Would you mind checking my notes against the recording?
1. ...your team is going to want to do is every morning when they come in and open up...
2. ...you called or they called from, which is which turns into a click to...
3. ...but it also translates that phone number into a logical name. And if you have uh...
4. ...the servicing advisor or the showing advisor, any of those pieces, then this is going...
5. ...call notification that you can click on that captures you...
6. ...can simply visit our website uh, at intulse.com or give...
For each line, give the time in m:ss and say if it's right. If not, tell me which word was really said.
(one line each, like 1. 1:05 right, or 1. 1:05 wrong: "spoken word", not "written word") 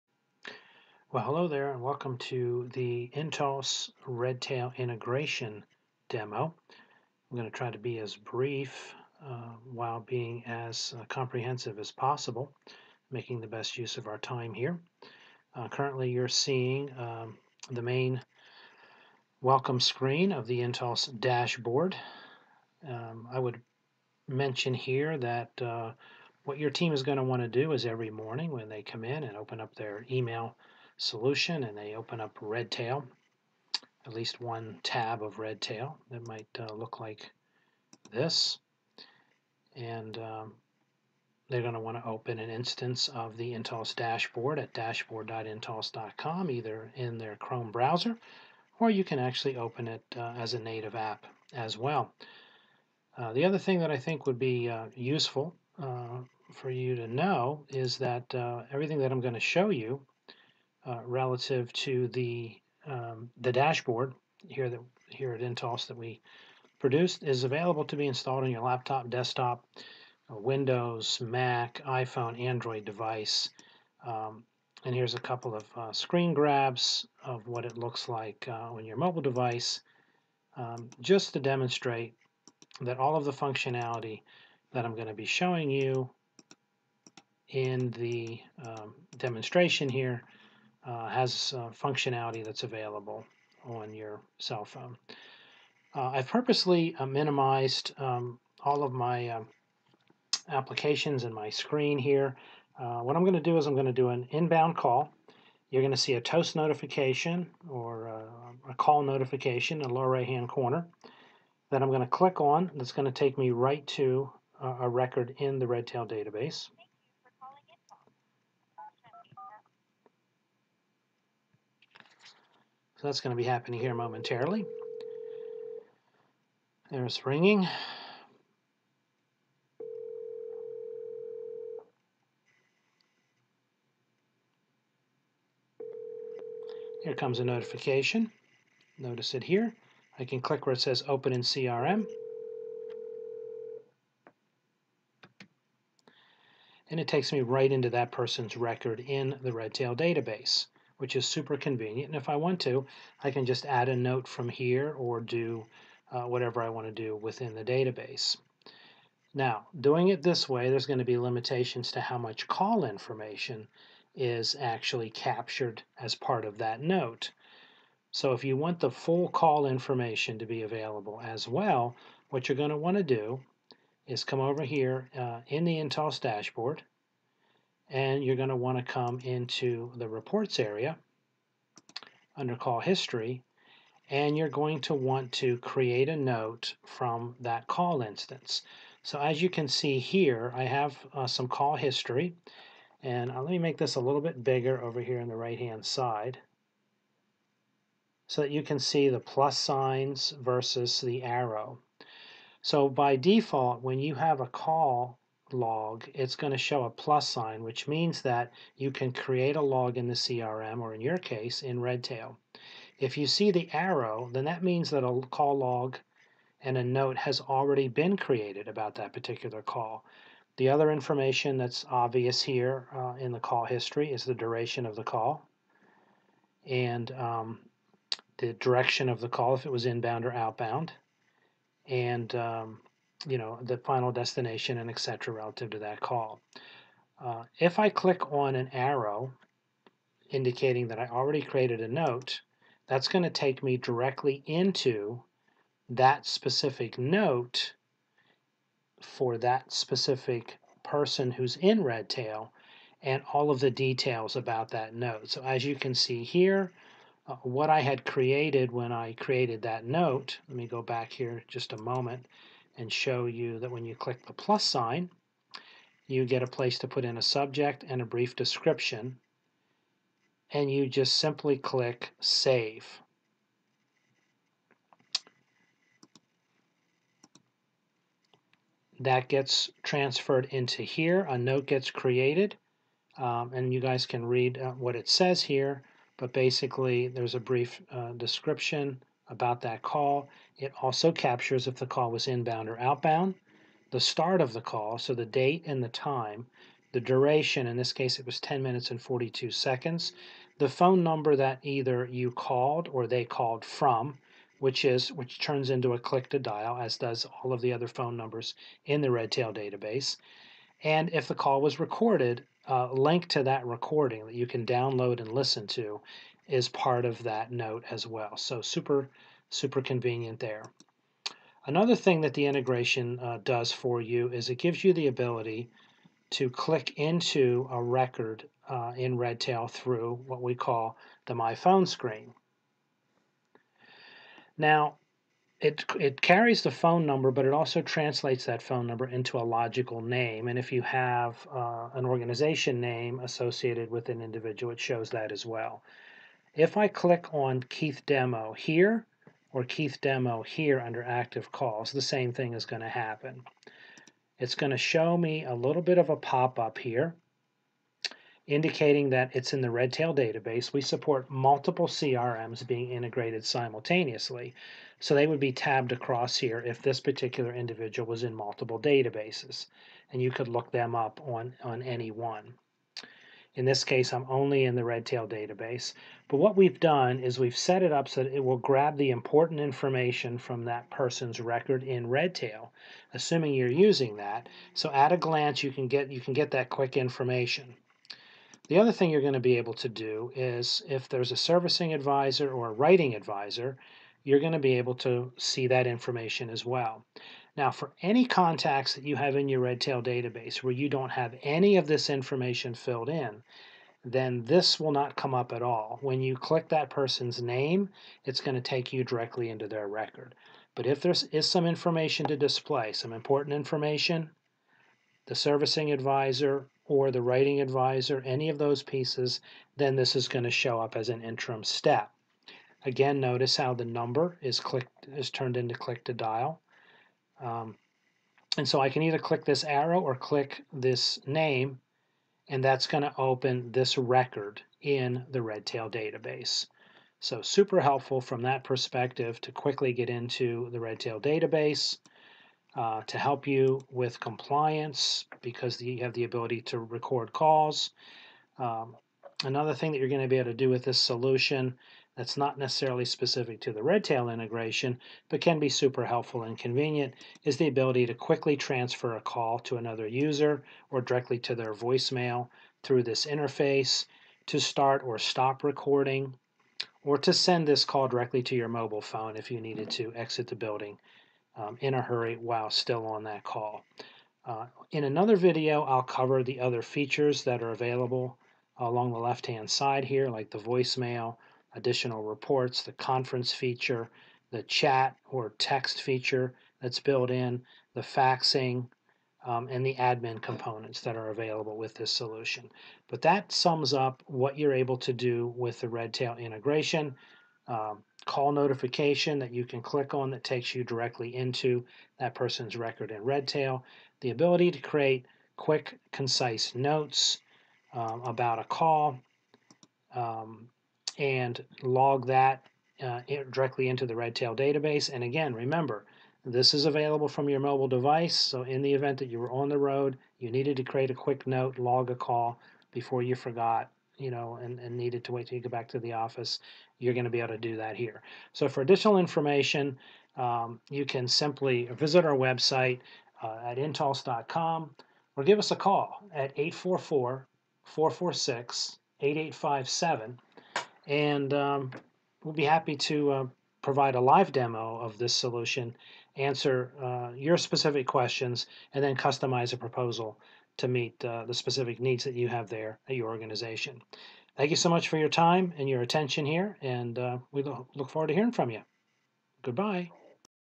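1. 0:26 right
2. 5:02 right
3. 5:37 right
4. 6:55 wrong: "writing", not "showing"
5. 8:18 wrong: "takes", not "captures"
6. 8:51 right.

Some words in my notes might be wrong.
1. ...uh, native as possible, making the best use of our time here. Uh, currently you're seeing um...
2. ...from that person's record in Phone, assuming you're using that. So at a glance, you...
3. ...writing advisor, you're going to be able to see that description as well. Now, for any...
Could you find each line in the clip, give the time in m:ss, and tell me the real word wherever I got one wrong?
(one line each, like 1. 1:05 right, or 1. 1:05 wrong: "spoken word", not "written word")
1. 0:10 wrong: "comprehensive", not "native"
2. 6:20 wrong: "Redtail", not "Phone"
3. 6:32 wrong: "information", not "description".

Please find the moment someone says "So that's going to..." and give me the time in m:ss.
2:03.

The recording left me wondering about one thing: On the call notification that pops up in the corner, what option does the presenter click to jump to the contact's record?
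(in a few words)
Open in CRM.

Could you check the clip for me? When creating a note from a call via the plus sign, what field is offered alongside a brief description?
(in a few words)
subject.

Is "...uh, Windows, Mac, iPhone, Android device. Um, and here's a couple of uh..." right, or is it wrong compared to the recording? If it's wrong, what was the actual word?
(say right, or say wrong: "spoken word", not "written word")
right.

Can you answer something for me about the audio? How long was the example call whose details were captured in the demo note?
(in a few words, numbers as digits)
10 minutes and 42 seconds.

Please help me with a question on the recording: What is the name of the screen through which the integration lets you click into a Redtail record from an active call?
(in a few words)
My Phone.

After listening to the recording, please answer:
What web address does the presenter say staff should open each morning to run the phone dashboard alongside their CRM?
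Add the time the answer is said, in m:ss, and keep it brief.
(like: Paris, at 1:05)
dashboard.intulse.com, at 0:44.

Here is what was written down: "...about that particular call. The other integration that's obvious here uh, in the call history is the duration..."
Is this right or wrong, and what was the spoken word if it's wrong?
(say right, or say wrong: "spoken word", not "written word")
wrong: "information", not "integration".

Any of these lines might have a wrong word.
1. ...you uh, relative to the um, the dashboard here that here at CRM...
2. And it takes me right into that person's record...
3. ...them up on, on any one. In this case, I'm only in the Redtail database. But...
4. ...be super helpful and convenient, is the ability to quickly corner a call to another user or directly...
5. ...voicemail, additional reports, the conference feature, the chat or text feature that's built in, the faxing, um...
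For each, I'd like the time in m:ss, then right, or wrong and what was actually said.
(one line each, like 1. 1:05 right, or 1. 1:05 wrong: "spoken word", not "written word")
1. 0:59 wrong: "Intulse", not "CRM"
2. 2:26 right
3. 6:10 right
4. 7:35 wrong: "transfer", not "corner"
5. 8:00 right.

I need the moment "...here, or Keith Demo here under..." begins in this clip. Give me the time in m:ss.
5:48.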